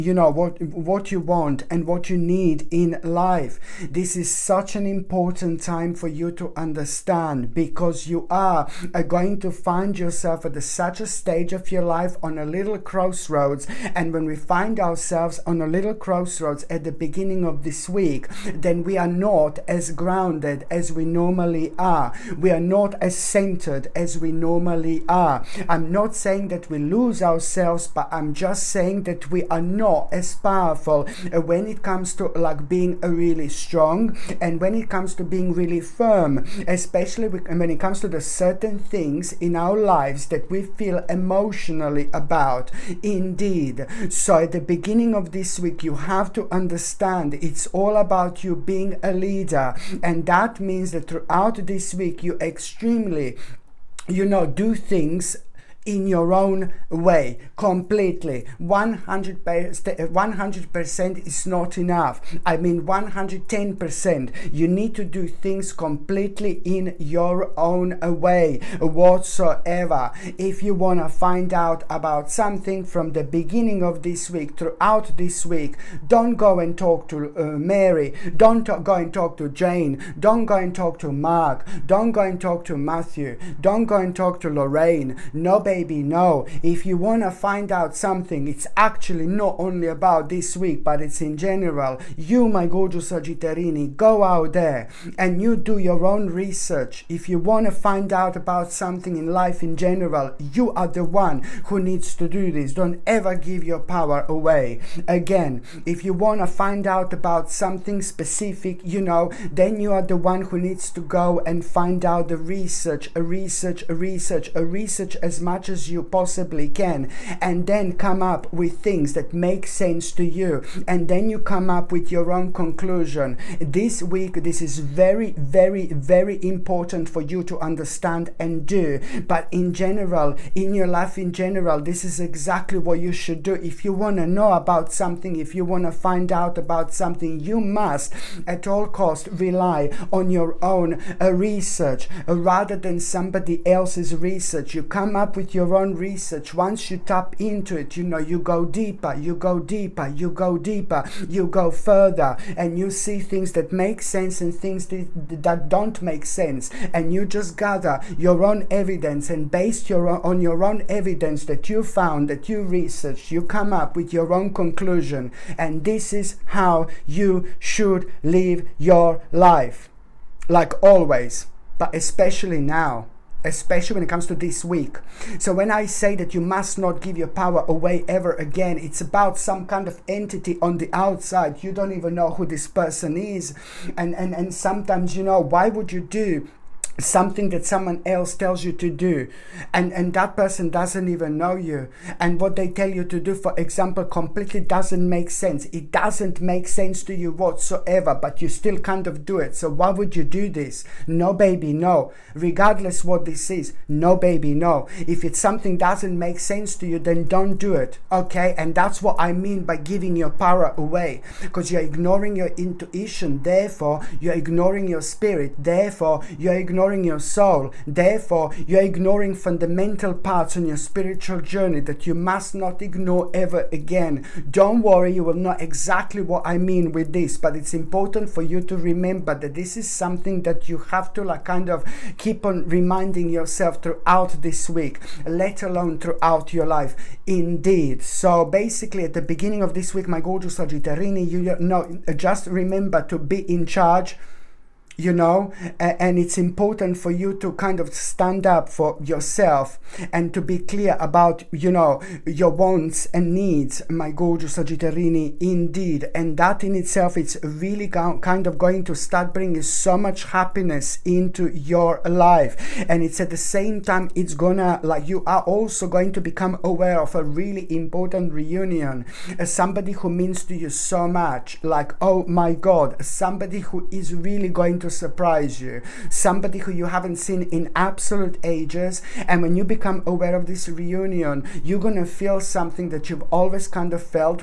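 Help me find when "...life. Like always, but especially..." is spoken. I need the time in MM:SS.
02:49.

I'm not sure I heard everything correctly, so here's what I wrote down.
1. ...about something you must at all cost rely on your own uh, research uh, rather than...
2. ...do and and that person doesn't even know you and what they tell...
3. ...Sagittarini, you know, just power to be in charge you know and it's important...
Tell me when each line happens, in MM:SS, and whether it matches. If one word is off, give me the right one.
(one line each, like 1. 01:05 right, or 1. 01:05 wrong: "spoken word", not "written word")
1. 02:16 right
2. 03:08 right
3. 04:00 wrong: "remember", not "power".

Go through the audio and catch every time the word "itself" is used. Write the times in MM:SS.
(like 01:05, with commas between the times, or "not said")
04:16.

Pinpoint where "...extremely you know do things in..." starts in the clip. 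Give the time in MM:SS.
00:52.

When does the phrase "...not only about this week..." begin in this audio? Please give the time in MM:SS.
01:29.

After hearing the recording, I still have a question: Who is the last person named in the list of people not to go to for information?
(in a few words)
Lorraine.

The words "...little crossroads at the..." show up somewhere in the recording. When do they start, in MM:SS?
00:15.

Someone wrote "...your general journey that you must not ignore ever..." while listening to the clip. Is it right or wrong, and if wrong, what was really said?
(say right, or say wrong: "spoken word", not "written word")
wrong: "spiritual", not "general".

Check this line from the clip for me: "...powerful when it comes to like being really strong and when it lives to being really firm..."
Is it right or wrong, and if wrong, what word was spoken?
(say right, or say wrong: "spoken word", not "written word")
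wrong: "comes", not "lives".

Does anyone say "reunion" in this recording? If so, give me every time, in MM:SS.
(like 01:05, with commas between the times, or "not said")
04:28, 04:40.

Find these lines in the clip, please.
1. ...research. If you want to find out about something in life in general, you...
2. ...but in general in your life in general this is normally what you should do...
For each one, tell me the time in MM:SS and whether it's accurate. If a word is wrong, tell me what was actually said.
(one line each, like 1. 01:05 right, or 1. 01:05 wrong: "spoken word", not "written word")
1. 01:36 right
2. 02:09 wrong: "exactly", not "normally".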